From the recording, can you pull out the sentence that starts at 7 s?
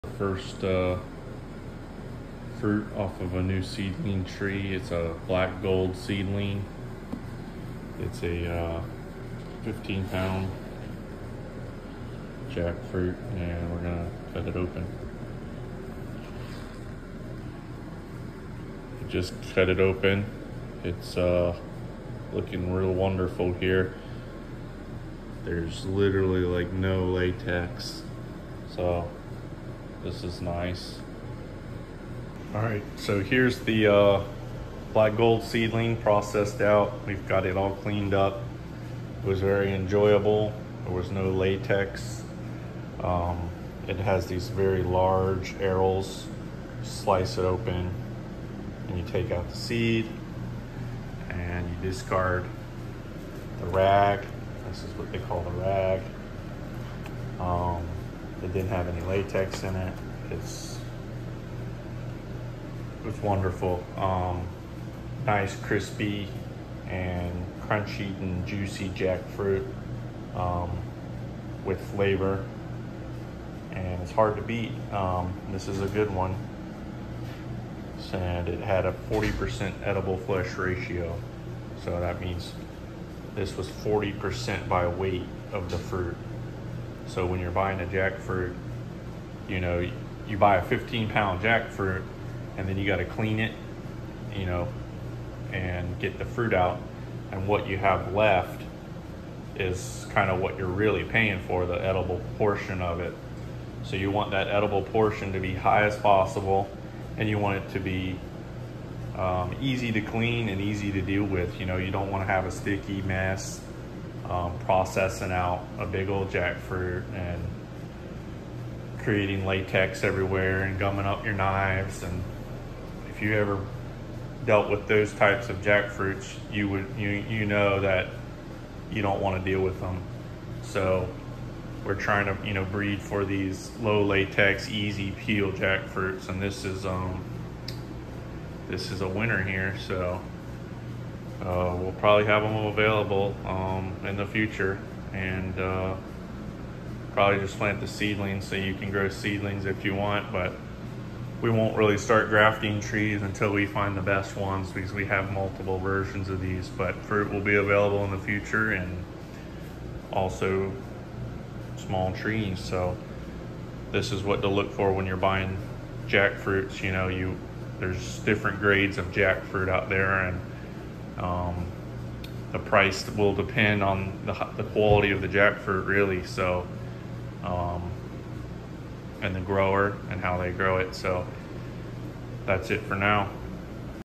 It's a uh, 15 pound jackfruit and we're gonna cut it open.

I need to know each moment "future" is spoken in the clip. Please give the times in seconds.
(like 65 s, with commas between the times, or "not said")
144 s, 158 s.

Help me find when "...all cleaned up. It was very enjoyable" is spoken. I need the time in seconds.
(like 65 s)
37 s.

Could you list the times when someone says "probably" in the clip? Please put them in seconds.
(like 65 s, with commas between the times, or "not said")
141 s, 147 s.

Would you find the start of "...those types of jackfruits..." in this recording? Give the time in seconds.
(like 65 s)
124 s.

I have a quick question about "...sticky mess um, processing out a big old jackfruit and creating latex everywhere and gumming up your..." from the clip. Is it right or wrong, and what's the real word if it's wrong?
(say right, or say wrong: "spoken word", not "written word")
right.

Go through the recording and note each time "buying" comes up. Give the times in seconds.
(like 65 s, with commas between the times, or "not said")
87 s, 165 s.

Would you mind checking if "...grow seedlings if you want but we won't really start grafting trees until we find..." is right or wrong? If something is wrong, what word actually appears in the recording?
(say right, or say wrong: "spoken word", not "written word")
right.